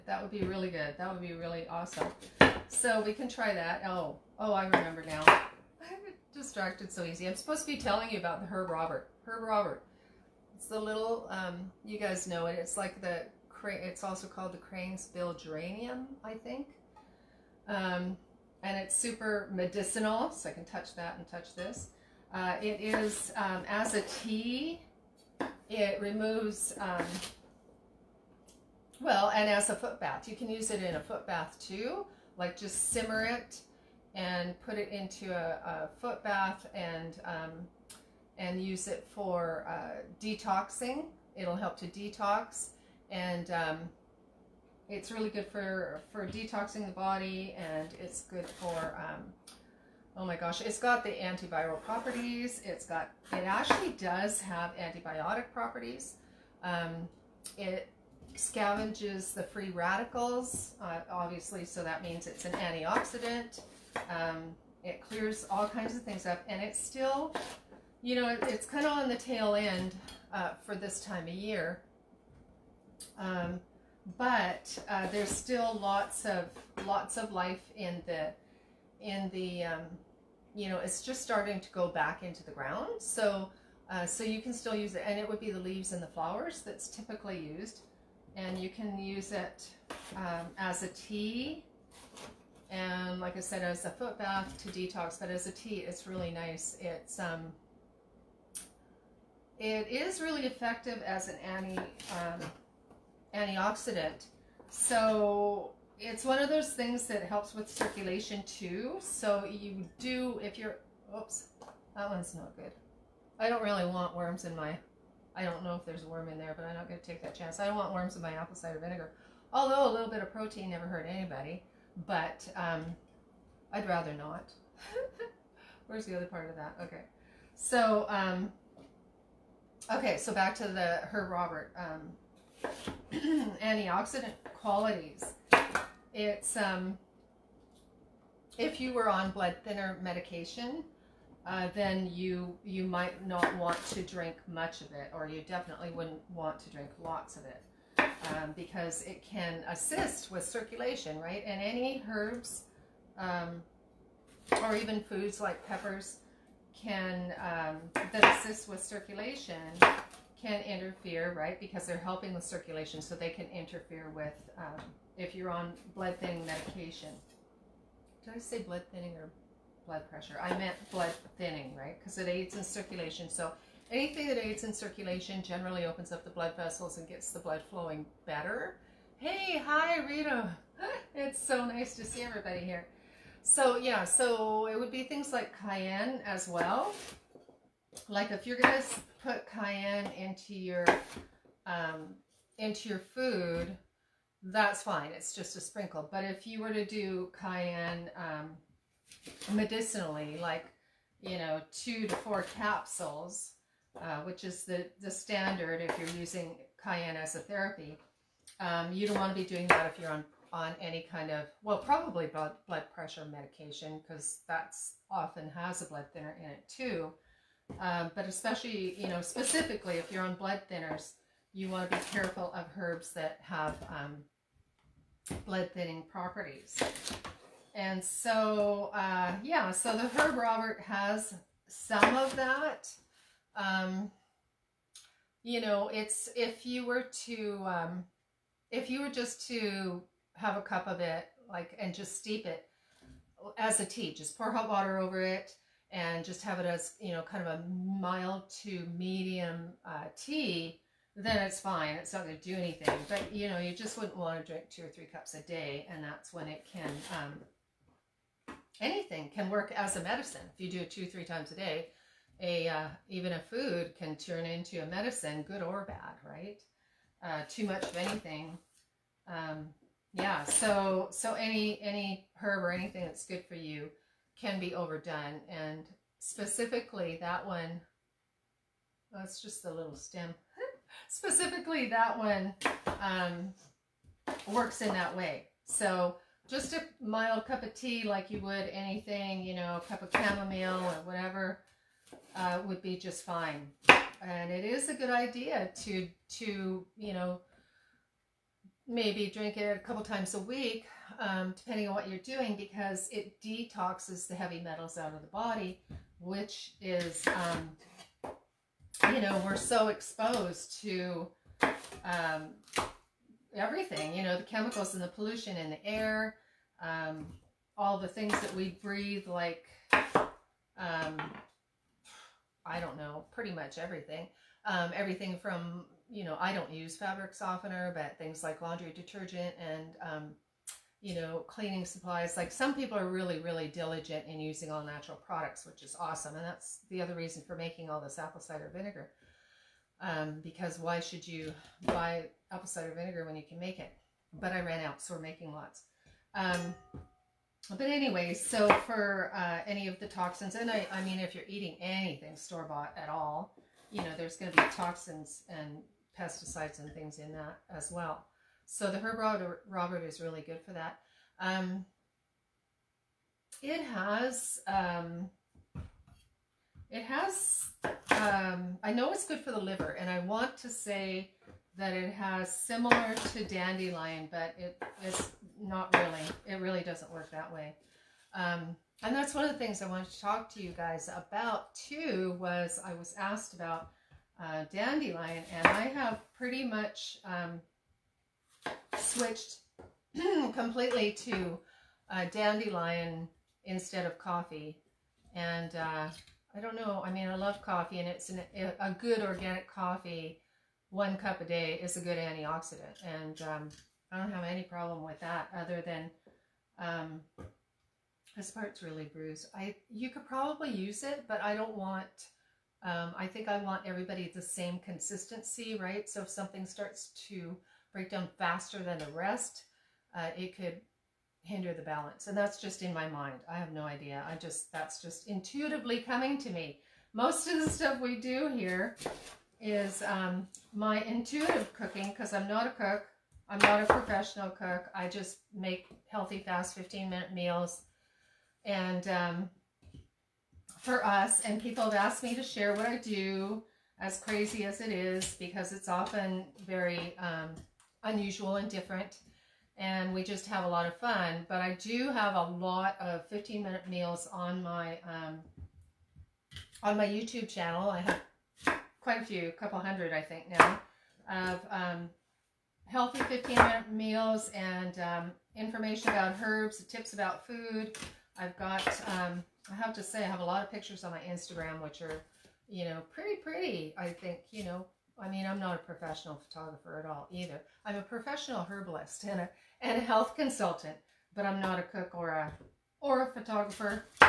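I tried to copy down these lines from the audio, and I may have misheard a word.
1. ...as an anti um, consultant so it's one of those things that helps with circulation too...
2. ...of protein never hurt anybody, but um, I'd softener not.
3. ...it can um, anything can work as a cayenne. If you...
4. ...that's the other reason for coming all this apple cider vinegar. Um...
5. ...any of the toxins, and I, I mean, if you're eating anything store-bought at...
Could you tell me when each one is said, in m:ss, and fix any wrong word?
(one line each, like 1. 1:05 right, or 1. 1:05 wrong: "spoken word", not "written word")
1. 1:41 wrong: "antioxidant", not "consultant"
2. 2:00 wrong: "rather", not "softener"
3. 4:16 wrong: "medicine", not "cayenne"
4. 5:36 wrong: "making", not "coming"
5. 5:49 right.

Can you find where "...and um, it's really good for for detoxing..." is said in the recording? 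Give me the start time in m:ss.
0:43.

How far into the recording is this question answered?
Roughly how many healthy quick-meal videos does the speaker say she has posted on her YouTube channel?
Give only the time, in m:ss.
7:39.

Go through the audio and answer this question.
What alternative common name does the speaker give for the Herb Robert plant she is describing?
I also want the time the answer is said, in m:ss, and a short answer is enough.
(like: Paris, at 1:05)
crane's bill geranium, at 0:14.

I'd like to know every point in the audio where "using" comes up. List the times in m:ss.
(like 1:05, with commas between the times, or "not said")
3:26, 5:34.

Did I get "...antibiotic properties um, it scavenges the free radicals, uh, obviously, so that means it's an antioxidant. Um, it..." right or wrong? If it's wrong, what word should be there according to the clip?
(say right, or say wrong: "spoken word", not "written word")
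right.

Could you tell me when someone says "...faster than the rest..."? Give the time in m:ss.
6:58.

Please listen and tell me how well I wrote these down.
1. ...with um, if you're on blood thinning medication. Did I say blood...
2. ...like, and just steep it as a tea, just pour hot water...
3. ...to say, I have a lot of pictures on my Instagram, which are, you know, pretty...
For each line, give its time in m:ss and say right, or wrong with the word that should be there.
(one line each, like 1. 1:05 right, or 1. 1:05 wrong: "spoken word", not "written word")
1. 2:44 right
2. 4:01 right
3. 7:49 right.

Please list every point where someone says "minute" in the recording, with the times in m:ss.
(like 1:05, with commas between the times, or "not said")
7:17, 7:33, 7:43.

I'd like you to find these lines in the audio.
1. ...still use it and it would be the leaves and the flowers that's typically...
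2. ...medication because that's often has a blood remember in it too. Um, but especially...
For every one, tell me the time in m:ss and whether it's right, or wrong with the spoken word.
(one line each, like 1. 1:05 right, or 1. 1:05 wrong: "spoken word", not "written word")
1. 1:24 right
2. 3:33 wrong: "thinner", not "remember".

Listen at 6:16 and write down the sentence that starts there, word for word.
It really doesn't work that way.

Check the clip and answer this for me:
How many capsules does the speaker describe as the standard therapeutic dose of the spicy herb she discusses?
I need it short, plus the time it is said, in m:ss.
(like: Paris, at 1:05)
2 to 4, at 3:21.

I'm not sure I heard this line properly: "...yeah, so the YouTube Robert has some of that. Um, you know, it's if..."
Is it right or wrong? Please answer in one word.
wrong.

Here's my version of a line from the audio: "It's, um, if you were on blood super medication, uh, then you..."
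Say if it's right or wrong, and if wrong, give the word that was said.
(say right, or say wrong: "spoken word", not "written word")
wrong: "thinner", not "super".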